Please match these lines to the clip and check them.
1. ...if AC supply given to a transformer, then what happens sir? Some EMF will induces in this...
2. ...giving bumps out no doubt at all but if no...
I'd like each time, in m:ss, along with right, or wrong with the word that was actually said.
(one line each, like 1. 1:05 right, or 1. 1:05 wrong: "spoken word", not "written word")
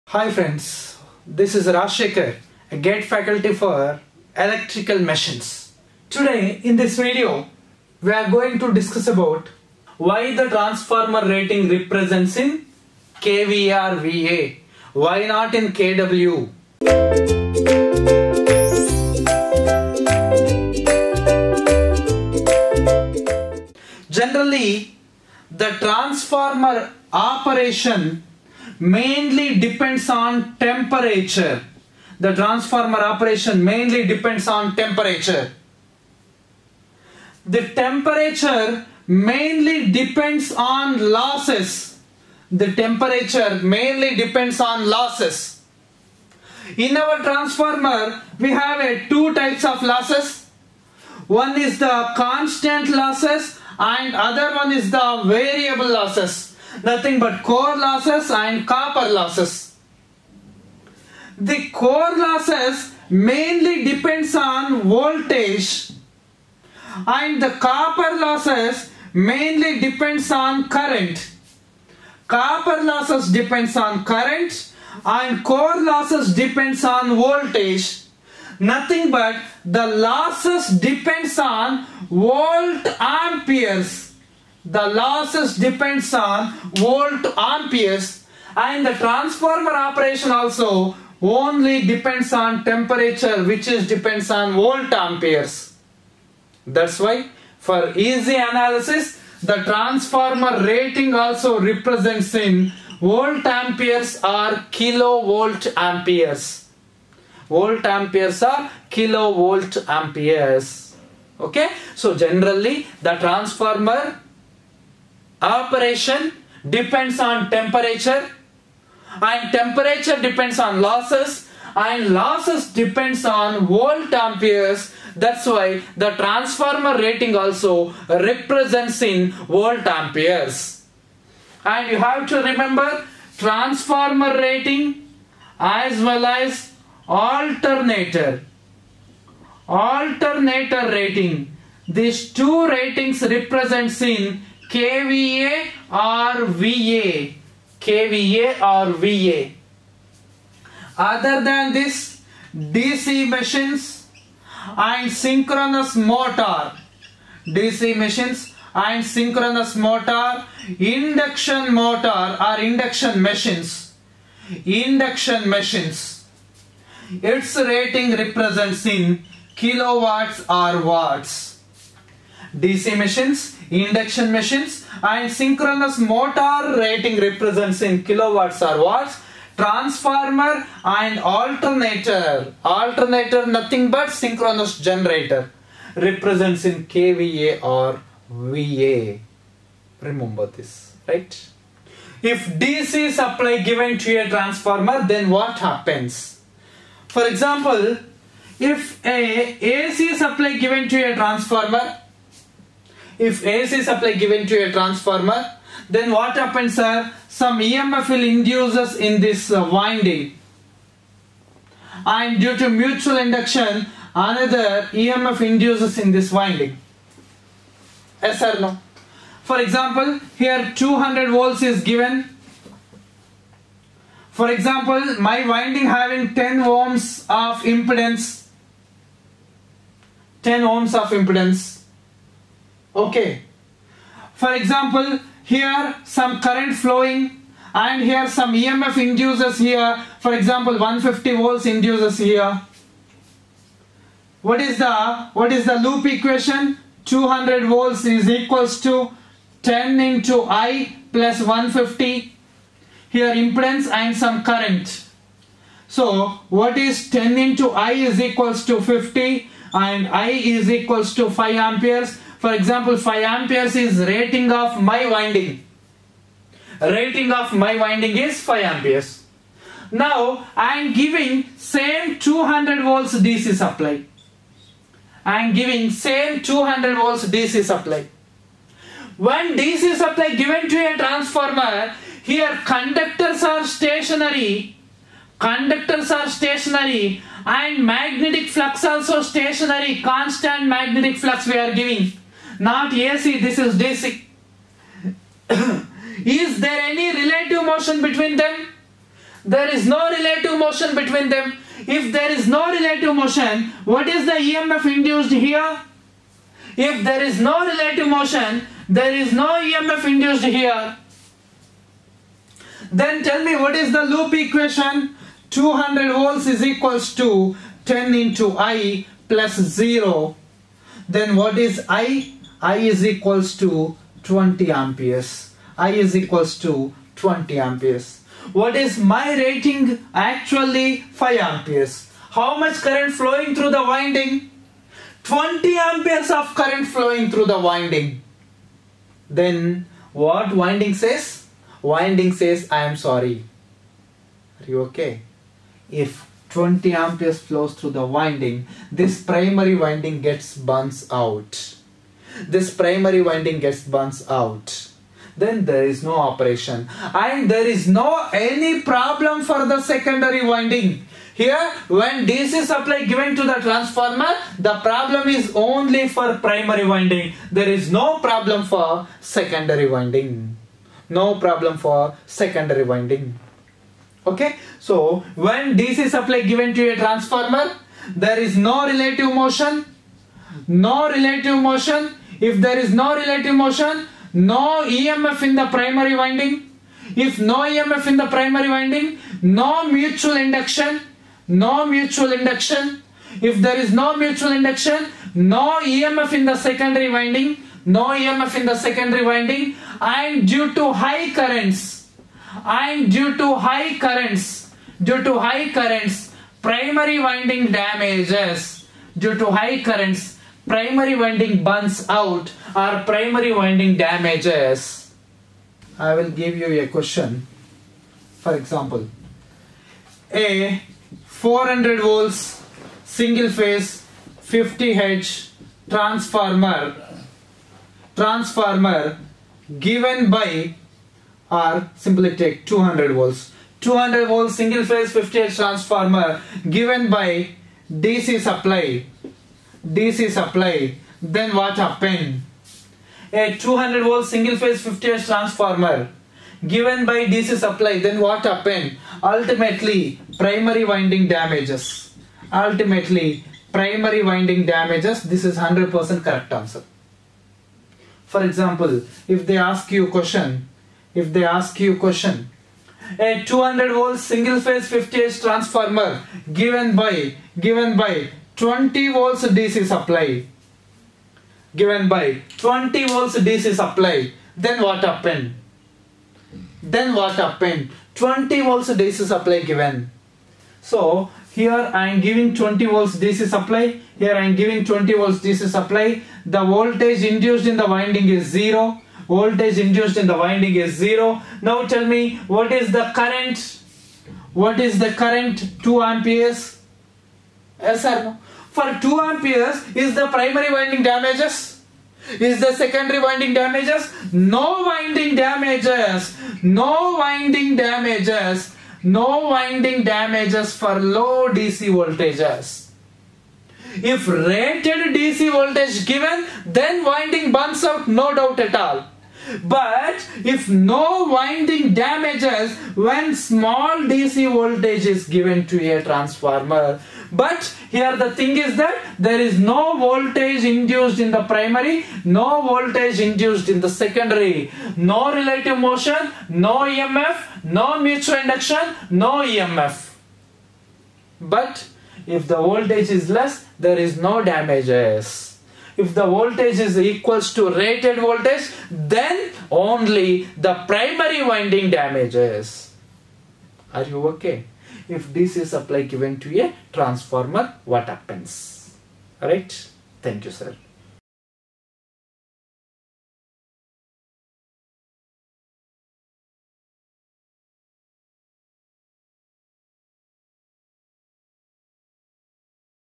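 1. 3:23 right
2. 8:37 wrong: "winding", not "giving".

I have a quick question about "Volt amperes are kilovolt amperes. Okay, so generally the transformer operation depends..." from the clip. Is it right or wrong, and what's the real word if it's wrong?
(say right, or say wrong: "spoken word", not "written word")
right.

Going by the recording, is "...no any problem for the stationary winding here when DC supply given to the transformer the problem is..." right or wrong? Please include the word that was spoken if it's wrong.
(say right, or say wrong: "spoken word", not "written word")
wrong: "secondary", not "stationary".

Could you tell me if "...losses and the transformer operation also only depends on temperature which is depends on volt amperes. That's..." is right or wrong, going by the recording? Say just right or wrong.
wrong.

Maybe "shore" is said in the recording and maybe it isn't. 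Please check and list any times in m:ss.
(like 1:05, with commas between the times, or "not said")
not said.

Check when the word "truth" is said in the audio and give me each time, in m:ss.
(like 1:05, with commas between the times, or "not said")
not said.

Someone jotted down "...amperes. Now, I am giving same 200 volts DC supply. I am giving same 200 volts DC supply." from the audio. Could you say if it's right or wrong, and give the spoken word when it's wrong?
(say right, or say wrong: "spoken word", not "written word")
right.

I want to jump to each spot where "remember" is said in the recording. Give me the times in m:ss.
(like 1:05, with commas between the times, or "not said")
2:12, 3:10.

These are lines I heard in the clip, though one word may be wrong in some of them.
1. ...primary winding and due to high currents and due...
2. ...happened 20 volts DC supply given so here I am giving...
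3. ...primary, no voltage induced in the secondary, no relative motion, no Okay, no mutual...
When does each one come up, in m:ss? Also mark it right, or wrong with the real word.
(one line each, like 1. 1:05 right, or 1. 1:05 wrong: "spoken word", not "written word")
1. 6:38 wrong: "secondary", not "primary"
2. 7:57 right
3. 8:51 wrong: "EMF", not "Okay".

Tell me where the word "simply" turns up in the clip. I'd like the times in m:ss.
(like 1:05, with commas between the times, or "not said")
7:12.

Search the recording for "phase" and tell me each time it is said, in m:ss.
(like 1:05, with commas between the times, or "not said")
7:03, 7:14, 7:24, 7:44.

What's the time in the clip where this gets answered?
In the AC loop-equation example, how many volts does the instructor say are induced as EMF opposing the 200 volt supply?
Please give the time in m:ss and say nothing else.
4:00.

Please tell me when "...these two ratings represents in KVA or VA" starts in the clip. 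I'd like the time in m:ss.
2:21.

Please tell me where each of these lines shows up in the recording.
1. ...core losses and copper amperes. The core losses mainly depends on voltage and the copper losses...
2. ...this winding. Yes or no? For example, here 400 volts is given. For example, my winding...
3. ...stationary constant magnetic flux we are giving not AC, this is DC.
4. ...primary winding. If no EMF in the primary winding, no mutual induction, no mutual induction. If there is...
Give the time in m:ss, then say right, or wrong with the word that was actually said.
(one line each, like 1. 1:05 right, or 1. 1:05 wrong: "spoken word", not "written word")
1. 0:57 wrong: "losses", not "amperes"
2. 3:36 wrong: "200", not "400"
3. 4:49 right
4. 6:25 right.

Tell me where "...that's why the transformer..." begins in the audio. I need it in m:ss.
2:05.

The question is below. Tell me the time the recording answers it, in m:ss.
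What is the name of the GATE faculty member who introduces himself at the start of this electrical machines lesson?
0:01.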